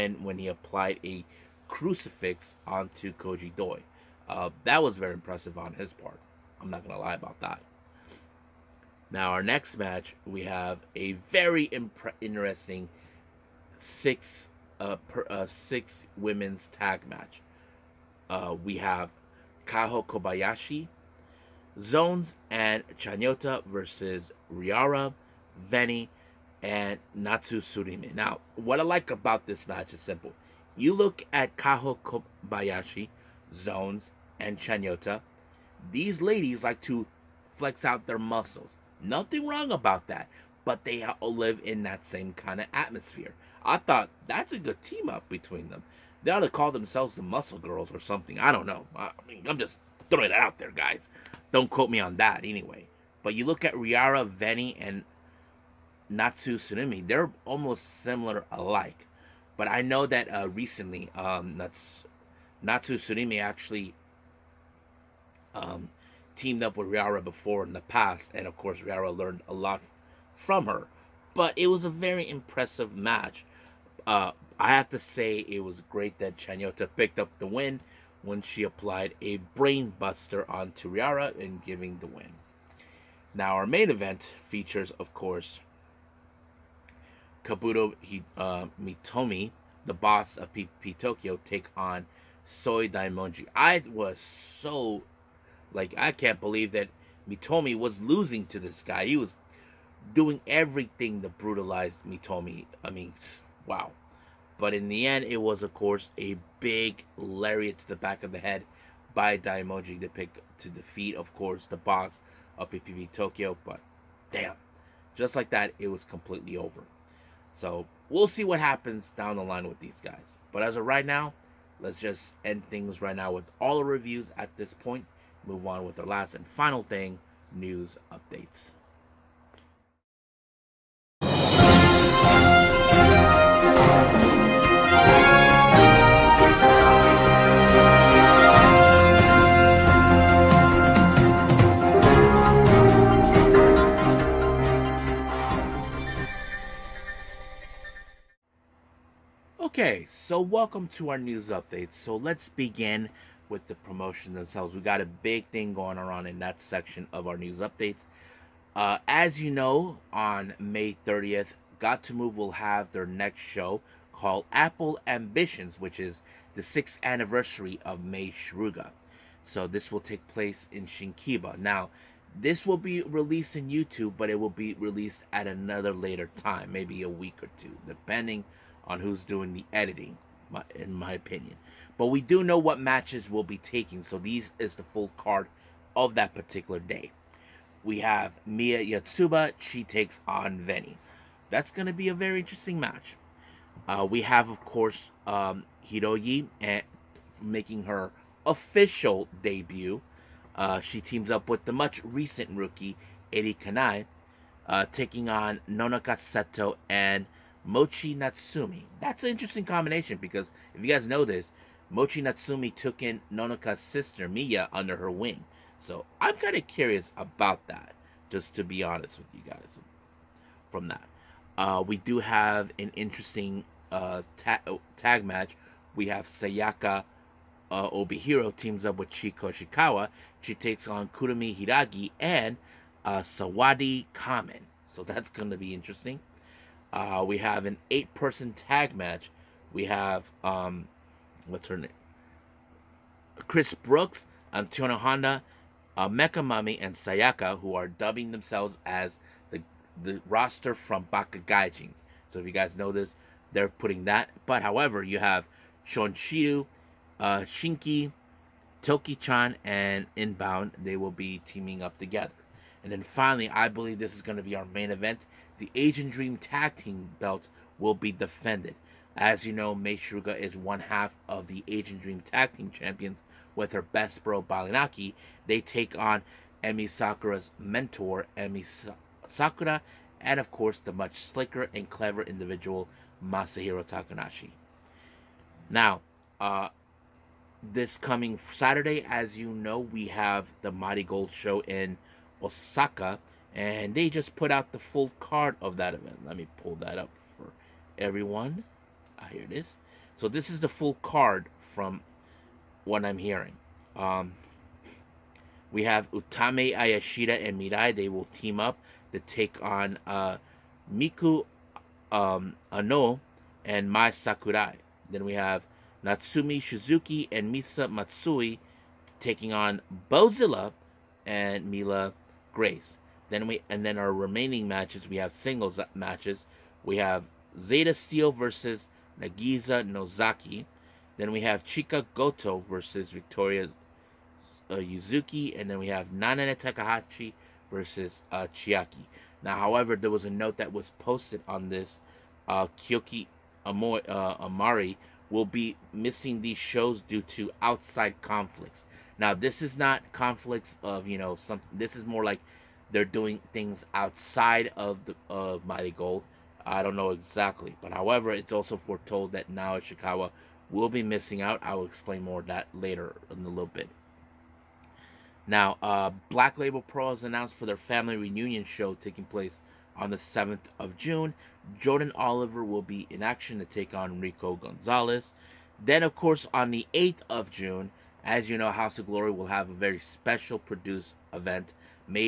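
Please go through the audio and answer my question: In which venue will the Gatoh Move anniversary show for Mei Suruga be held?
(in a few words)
Shinkiba.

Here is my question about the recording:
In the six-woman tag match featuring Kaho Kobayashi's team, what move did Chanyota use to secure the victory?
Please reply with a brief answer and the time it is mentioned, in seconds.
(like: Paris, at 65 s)
Brainbuster, at 79 s.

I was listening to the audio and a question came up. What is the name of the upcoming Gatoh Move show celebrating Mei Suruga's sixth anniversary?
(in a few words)
Apple Ambitions.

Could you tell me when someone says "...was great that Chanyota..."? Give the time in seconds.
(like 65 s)
75 s.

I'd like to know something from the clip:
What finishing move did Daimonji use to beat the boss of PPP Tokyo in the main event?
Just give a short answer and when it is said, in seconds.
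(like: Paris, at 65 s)
Lariat, at 107 s.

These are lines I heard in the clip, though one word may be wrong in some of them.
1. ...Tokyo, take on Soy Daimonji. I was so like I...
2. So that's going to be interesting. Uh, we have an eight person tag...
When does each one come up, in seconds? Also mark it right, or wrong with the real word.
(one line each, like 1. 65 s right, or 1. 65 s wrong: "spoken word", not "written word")
1. 90 s right
2. 234 s right.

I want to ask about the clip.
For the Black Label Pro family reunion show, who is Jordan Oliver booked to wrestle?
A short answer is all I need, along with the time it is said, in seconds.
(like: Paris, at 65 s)
Rico Gonzalez, at 374 s.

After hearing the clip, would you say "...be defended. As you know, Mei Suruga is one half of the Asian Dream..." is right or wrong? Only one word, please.
right.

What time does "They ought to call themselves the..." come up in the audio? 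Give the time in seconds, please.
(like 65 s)
46 s.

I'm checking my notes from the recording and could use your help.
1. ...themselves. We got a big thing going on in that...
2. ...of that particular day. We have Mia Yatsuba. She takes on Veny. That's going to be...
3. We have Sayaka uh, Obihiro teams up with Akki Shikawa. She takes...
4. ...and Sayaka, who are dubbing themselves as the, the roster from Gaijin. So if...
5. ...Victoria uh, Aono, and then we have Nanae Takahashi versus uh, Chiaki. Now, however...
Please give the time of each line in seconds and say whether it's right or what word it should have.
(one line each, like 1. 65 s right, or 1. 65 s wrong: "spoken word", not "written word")
1. 154 s right
2. 185 s right
3. 225 s wrong: "Chiko", not "Akki"
4. 246 s right
5. 333 s wrong: "Yuzuki", not "Aono".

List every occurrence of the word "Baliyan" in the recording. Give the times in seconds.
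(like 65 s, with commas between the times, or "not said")
274 s.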